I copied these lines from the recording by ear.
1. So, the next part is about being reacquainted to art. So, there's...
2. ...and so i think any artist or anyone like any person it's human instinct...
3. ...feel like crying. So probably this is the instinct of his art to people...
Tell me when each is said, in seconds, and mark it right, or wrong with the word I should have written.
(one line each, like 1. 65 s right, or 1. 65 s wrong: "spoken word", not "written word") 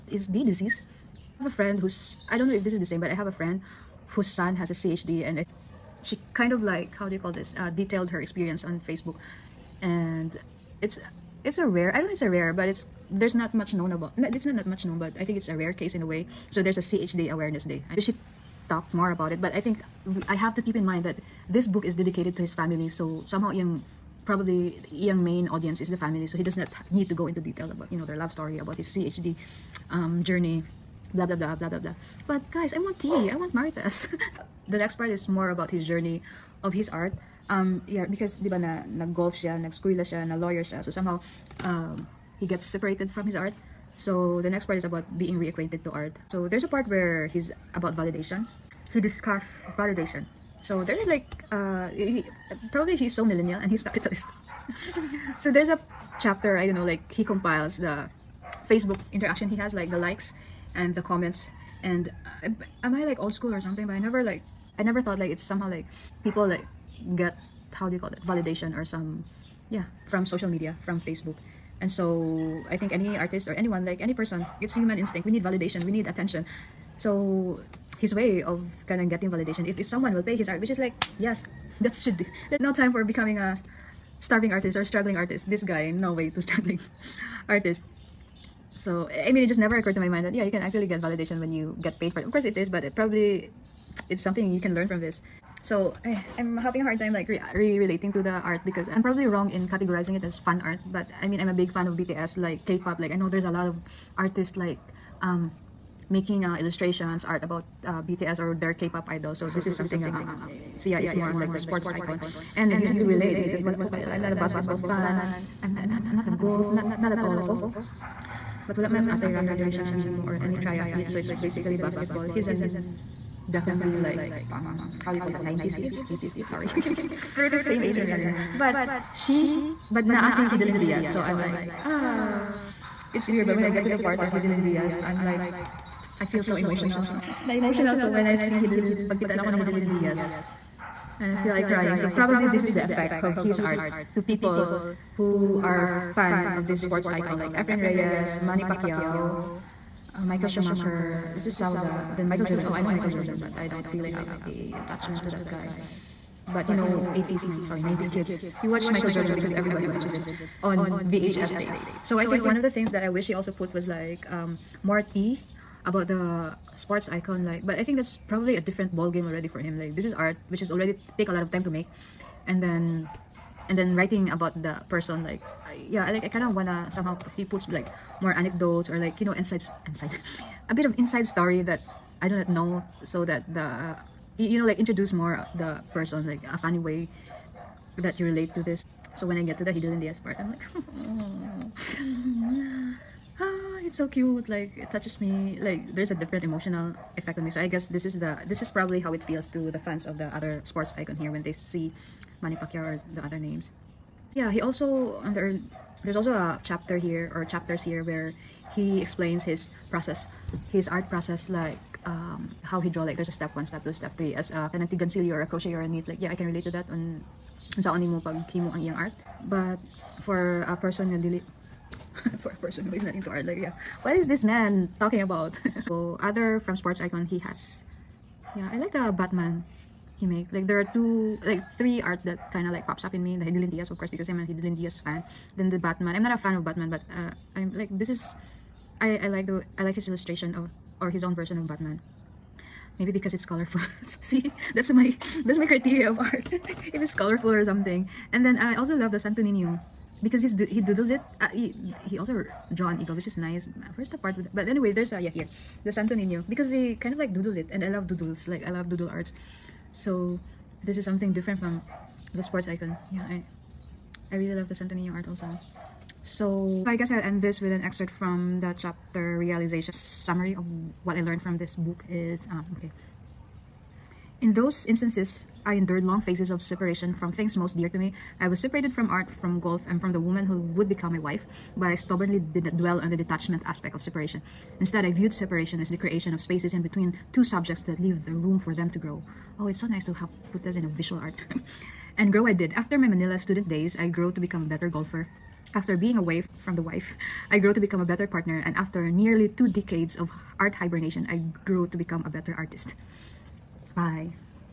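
1. 43 s right
2. 71 s right
3. 141 s wrong: "effect", not "instinct".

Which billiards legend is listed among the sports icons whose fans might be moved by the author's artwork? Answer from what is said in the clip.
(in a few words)
Efren Reyes.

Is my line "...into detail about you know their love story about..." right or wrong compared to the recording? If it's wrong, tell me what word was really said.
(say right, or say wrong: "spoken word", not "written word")
right.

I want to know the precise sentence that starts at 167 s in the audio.
Like, but I think that's probably a different ball game already for him.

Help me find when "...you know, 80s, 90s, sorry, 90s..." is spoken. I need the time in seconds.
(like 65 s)
156 s.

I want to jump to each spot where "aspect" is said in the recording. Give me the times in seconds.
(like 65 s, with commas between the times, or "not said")
283 s.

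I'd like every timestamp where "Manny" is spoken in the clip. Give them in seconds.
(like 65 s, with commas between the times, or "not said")
148 s, 202 s.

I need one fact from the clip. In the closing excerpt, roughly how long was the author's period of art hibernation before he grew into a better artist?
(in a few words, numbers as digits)
Nearly two decades.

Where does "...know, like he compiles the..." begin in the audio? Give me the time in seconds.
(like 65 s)
56 s.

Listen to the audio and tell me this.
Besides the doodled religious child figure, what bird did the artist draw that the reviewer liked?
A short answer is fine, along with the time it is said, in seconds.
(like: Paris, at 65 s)
Eagle, at 252 s.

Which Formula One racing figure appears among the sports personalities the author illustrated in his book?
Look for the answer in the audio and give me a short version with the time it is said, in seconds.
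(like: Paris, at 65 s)
Michael Schumacher, at 150 s.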